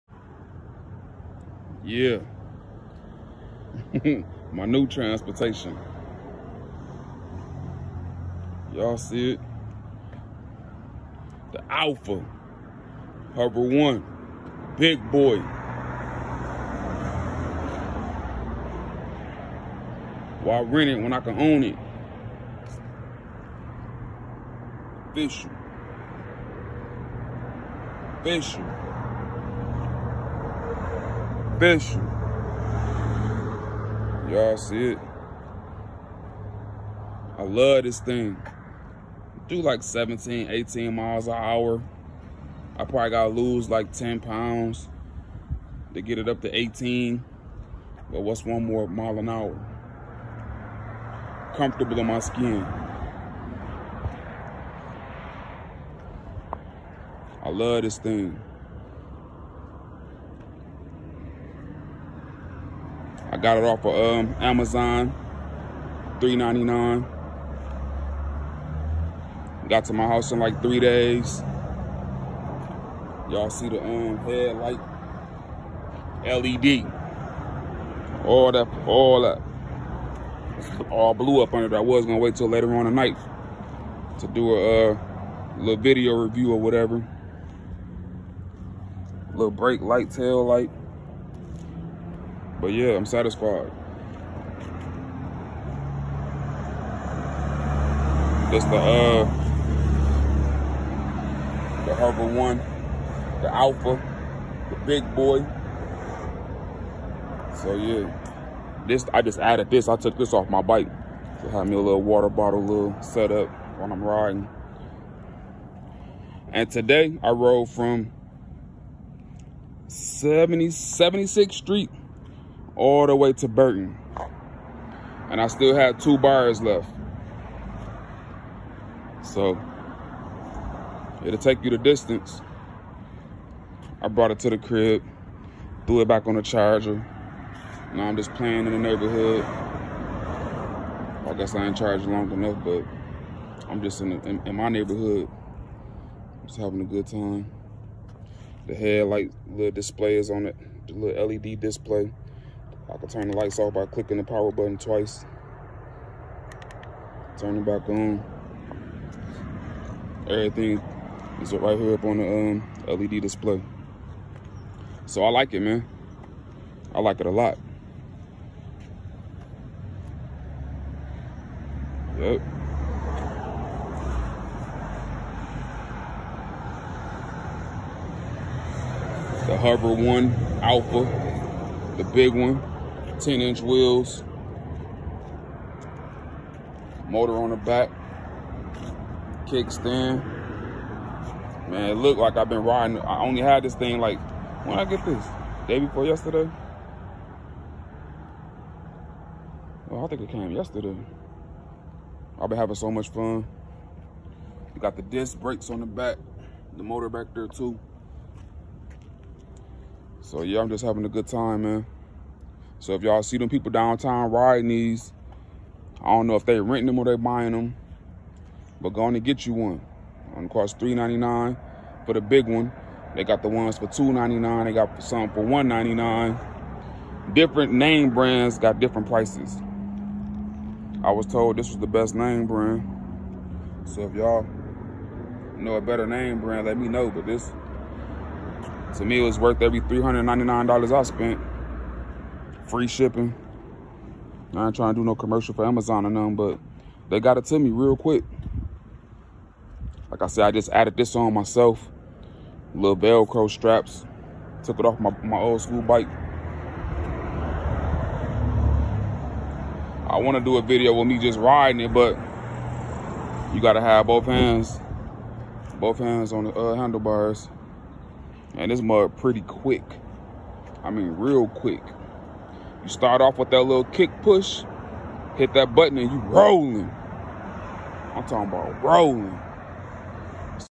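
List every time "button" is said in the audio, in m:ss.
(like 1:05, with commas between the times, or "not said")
2:34, 4:35.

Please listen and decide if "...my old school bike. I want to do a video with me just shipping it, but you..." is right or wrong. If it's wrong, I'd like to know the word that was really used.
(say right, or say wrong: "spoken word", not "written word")
wrong: "riding", not "shipping".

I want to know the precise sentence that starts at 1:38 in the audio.
That's the uh the Hover One, the Alpha, the Big Boy.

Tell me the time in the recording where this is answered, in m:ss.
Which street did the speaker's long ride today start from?
2:00.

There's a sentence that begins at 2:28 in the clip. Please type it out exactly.
The headlight little display is on it, the little LED display.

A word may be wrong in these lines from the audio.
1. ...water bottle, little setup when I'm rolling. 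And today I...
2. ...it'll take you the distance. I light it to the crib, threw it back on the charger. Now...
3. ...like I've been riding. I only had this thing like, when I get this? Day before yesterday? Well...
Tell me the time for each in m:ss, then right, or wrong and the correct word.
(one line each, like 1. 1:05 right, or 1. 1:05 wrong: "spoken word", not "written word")
1. 1:52 wrong: "riding", not "rolling"
2. 2:11 wrong: "brought", not "light"
3. 3:12 right.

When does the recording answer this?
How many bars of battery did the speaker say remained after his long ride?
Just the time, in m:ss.
2:05.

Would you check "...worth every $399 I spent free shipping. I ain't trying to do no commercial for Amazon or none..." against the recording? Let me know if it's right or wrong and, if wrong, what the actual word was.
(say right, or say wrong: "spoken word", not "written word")
right.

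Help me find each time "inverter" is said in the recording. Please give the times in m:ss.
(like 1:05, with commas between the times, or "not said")
not said.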